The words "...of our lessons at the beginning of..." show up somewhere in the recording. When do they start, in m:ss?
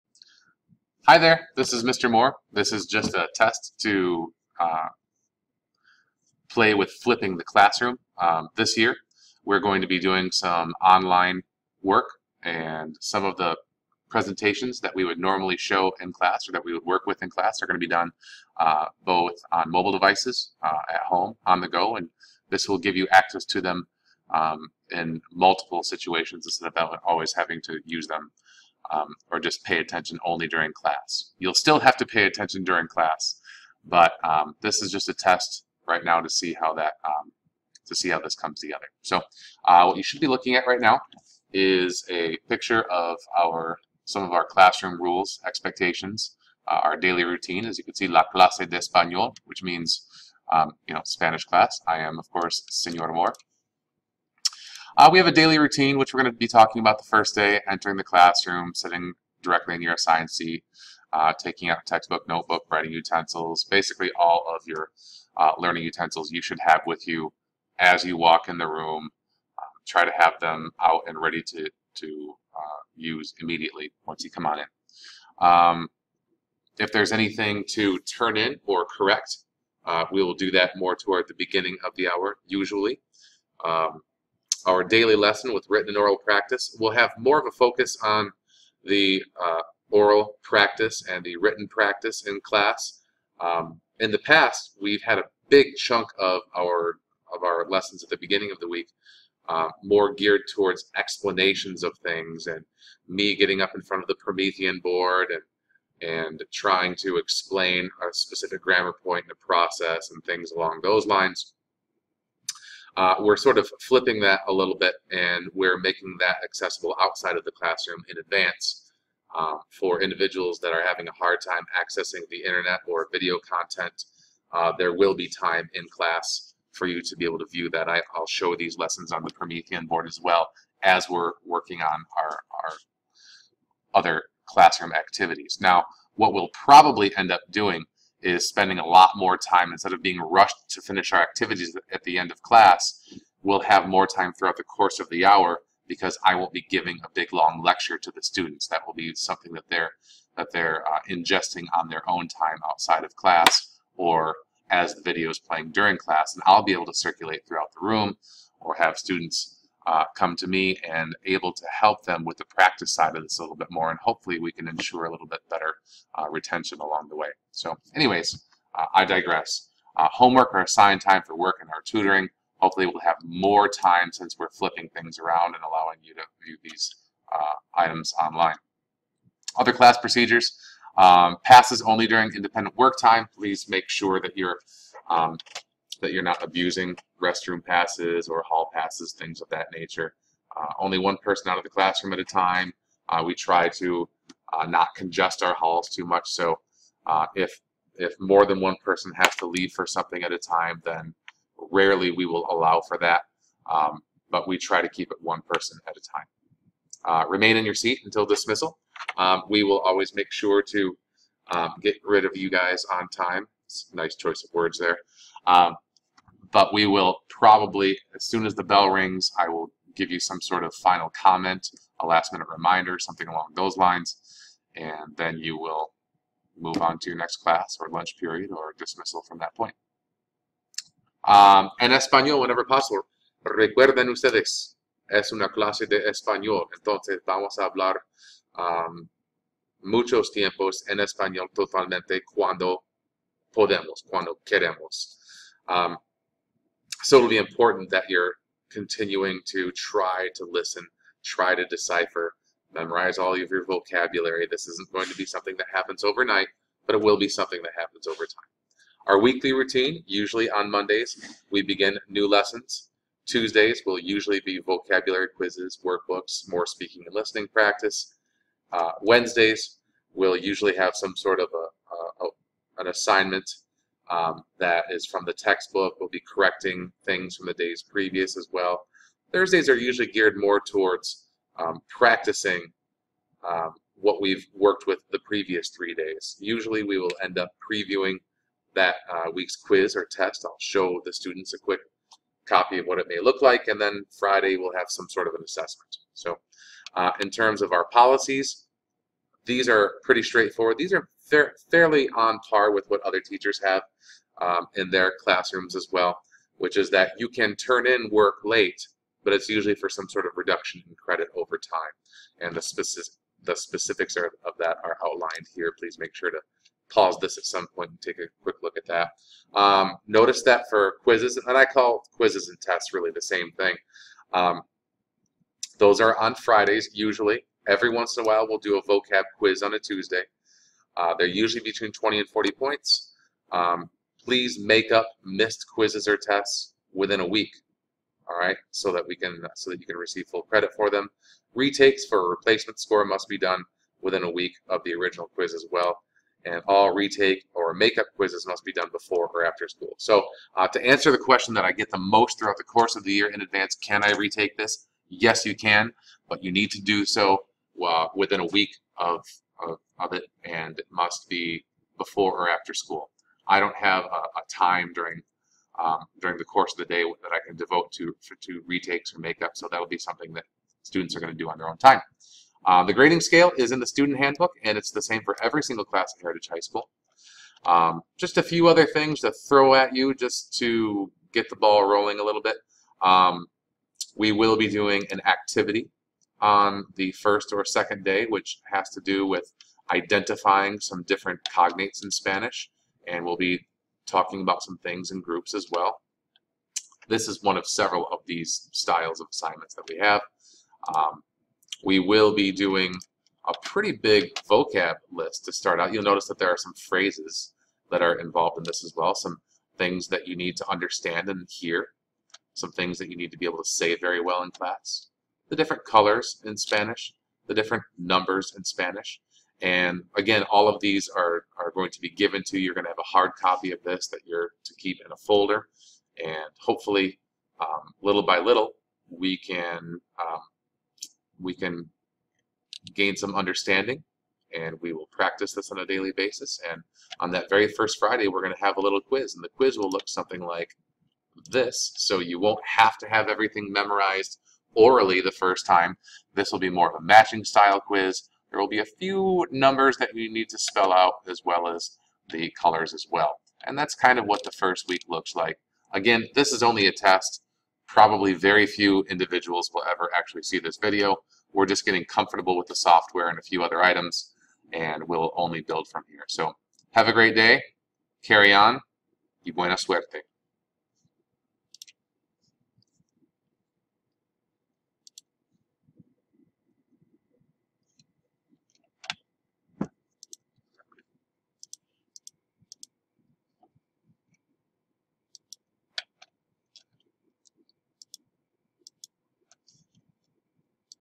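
1:37.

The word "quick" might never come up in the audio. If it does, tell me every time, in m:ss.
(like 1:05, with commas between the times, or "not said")
4:51, 5:18.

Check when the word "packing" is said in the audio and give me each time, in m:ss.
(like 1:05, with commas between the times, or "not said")
not said.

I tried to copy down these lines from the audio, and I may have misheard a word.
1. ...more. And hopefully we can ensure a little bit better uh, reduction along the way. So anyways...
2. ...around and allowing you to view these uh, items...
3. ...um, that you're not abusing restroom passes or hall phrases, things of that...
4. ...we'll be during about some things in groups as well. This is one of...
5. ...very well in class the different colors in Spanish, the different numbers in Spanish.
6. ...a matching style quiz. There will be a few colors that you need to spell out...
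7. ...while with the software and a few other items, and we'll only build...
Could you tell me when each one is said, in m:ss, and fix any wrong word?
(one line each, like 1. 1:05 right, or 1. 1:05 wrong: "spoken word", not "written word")
1. 2:43 wrong: "retention", not "reduction"
2. 2:55 right
3. 3:05 wrong: "passes", not "phrases"
4. 6:33 wrong: "talking", not "during"
5. 6:53 right
6. 7:26 wrong: "numbers", not "colors"
7. 7:42 wrong: "comfortable", not "while".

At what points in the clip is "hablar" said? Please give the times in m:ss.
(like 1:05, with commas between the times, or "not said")
3:57.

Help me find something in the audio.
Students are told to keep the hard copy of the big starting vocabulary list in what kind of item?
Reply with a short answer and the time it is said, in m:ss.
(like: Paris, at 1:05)
a folder, at 7:05.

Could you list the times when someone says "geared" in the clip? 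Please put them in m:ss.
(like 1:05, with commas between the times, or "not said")
1:40, 4:40.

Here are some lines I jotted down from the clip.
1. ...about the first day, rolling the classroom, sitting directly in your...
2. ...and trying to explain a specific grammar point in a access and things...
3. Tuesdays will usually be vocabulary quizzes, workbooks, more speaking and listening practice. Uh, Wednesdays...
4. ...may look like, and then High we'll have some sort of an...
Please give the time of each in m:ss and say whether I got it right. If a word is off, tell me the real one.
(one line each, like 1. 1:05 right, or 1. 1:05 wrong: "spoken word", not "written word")
1. 0:56 wrong: "entering", not "rolling"
2. 1:46 wrong: "process", not "access"
3. 4:23 right
4. 4:53 wrong: "Friday", not "High".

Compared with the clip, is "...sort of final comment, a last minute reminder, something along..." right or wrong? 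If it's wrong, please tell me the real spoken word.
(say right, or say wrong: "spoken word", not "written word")
right.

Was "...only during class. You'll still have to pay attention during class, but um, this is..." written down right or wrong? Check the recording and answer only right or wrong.
right.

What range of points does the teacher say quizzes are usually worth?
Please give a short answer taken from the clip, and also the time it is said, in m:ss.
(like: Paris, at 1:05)
20 to 40 points, at 5:31.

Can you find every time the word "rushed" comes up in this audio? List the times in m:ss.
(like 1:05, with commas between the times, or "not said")
2:20.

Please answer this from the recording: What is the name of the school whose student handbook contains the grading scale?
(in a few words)
Heritage High School.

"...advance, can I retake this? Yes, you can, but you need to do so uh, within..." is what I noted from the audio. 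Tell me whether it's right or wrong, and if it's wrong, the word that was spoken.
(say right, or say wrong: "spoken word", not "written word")
right.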